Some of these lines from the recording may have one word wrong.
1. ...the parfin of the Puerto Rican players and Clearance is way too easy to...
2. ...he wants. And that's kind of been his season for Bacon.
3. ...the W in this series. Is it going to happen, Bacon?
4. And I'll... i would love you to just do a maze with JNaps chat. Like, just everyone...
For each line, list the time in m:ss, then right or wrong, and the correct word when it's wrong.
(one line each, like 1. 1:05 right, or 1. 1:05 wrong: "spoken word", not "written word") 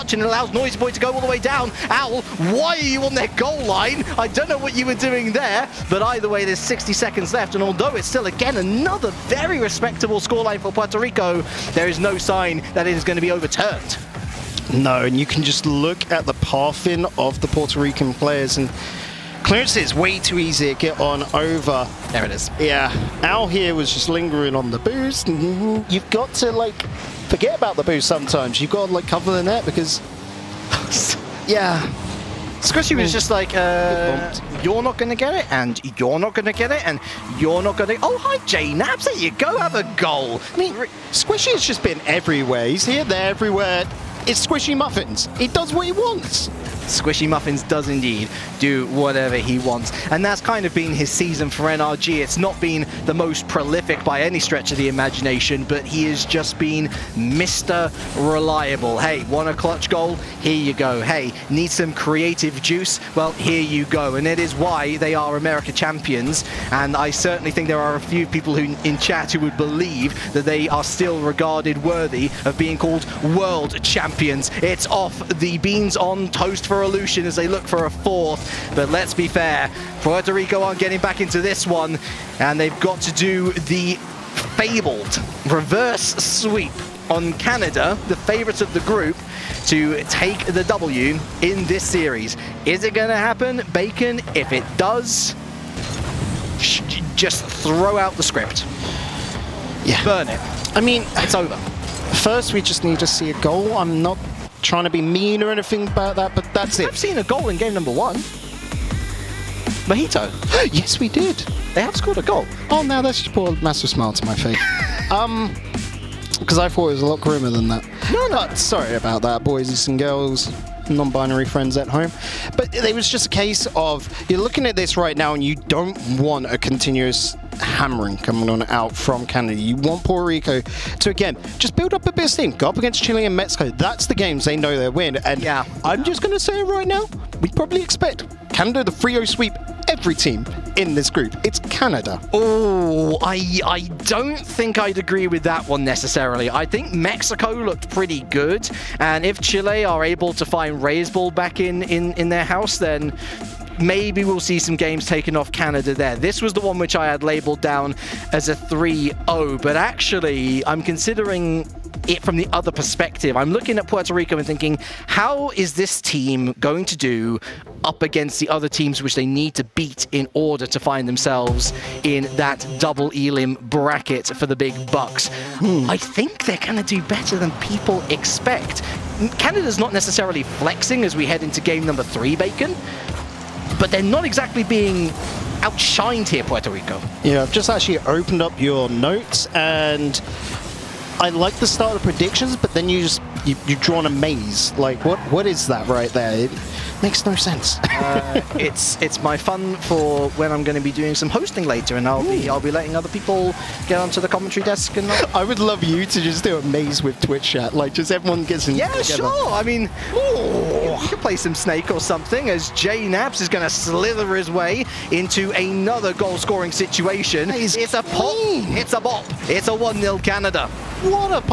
1. 0:16 right
2. 0:49 wrong: "NRG", not "Bacon"
3. 1:30 right
4. 3:24 wrong: "Twitch", not "JNaps".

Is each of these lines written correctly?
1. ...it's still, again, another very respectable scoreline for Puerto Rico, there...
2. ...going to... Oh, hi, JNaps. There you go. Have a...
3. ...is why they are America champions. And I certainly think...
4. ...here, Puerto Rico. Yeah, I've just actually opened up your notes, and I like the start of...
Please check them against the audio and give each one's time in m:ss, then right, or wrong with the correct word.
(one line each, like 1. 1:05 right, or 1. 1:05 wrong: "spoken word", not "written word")
1. 0:07 right
2. 0:37 right
3. 1:04 right
4. 3:06 right.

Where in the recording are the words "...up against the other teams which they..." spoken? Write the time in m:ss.
2:47.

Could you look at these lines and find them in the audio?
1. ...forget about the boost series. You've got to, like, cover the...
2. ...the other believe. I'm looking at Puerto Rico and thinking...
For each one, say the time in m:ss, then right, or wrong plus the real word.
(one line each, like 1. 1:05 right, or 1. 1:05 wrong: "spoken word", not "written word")
1. 0:27 wrong: "sometimes", not "series"
2. 2:42 wrong: "perspective", not "believe".